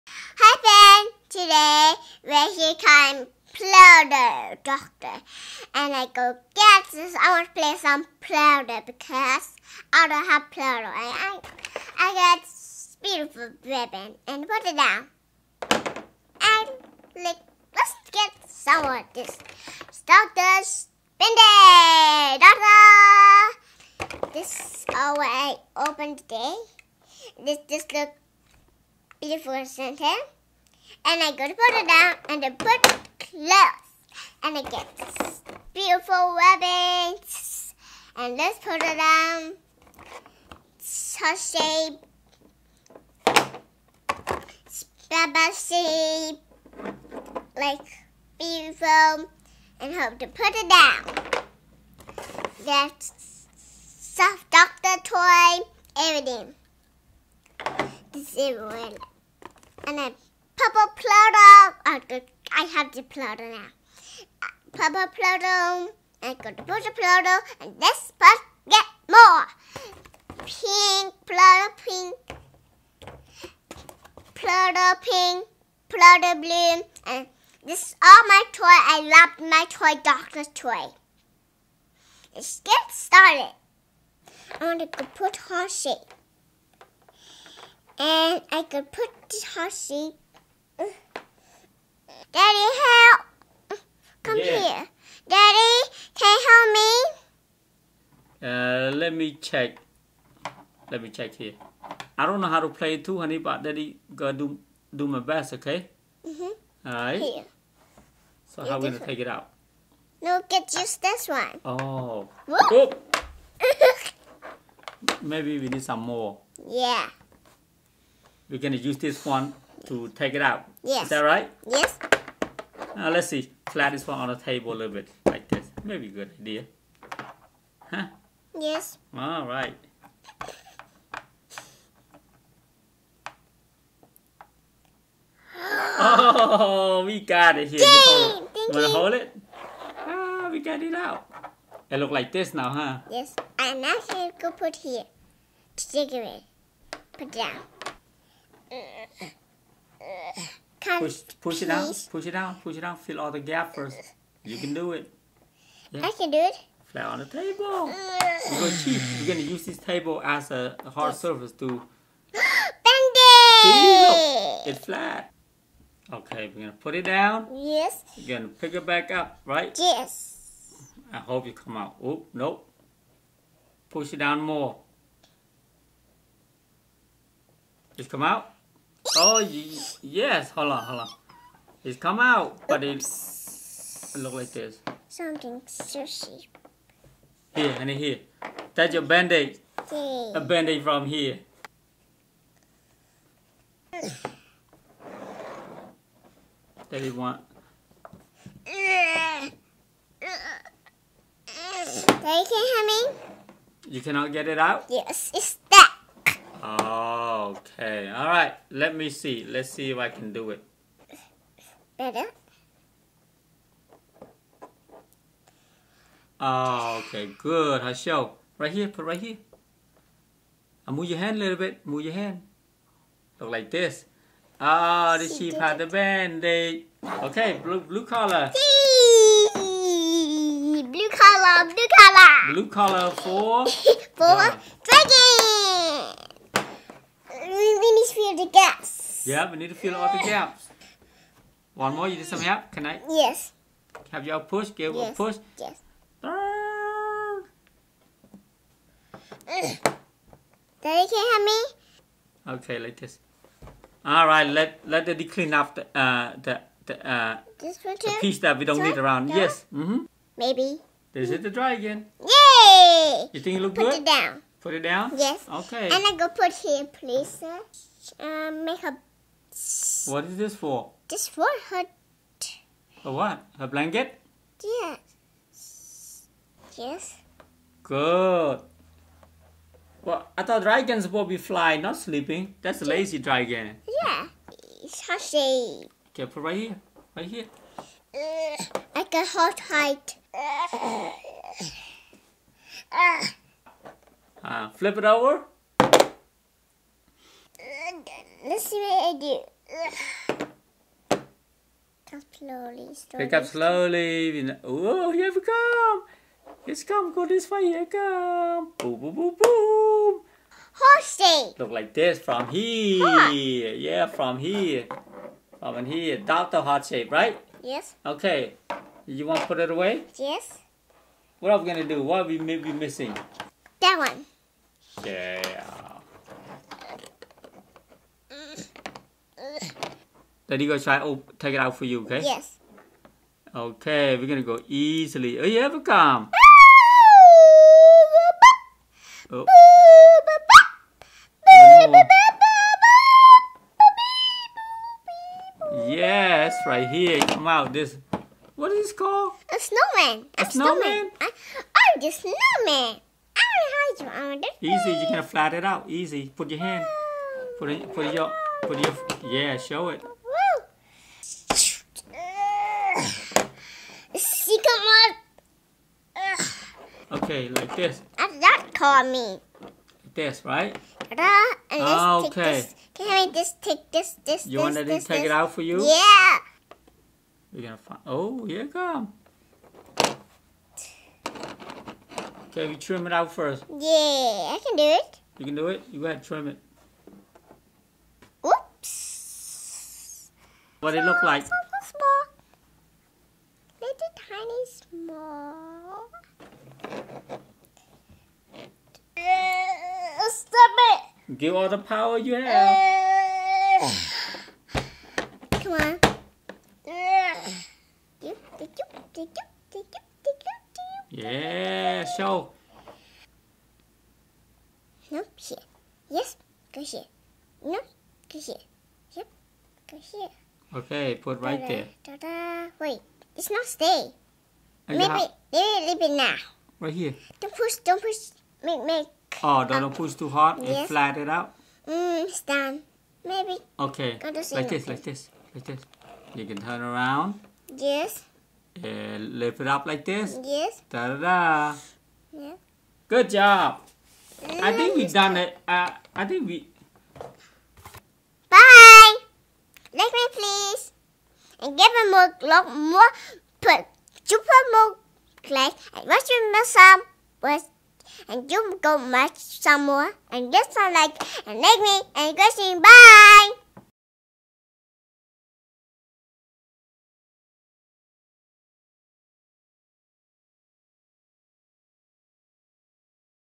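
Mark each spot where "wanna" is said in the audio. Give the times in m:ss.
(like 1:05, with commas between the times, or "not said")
2:18.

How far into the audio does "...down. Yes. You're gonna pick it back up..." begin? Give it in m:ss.
2:47.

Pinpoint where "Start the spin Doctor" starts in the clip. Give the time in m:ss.
0:19.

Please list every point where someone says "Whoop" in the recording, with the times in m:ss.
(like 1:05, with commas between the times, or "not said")
1:52, 6:28.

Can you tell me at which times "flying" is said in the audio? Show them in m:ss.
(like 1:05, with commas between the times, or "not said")
4:41.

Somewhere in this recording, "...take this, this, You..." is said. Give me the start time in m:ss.
6:13.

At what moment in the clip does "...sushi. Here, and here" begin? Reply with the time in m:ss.
3:05.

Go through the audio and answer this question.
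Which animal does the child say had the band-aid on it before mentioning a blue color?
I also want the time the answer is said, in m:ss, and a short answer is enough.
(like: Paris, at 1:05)
sheep, at 3:45.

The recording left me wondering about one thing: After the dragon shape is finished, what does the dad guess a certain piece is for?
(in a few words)
blanket.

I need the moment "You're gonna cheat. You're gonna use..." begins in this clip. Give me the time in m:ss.
2:38.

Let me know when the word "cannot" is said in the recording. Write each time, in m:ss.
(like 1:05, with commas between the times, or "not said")
3:24.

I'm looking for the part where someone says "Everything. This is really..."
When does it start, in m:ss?
0:55.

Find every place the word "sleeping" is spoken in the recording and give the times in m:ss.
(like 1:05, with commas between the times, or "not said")
4:41.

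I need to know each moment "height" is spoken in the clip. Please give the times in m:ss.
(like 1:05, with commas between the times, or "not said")
4:49.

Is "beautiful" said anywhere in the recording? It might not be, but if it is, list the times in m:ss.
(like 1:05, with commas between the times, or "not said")
0:13, 0:29, 0:35, 0:48.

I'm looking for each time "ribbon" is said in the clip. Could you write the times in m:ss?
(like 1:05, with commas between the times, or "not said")
0:13, 0:36.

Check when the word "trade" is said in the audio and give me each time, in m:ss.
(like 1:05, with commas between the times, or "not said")
not said.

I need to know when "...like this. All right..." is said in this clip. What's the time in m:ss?
4:12.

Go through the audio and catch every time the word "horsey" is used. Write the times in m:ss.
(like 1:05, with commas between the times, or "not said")
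1:29, 5:10.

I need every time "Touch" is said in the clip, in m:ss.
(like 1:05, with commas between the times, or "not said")
0:41.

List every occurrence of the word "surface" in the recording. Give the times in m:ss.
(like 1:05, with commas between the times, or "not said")
2:41.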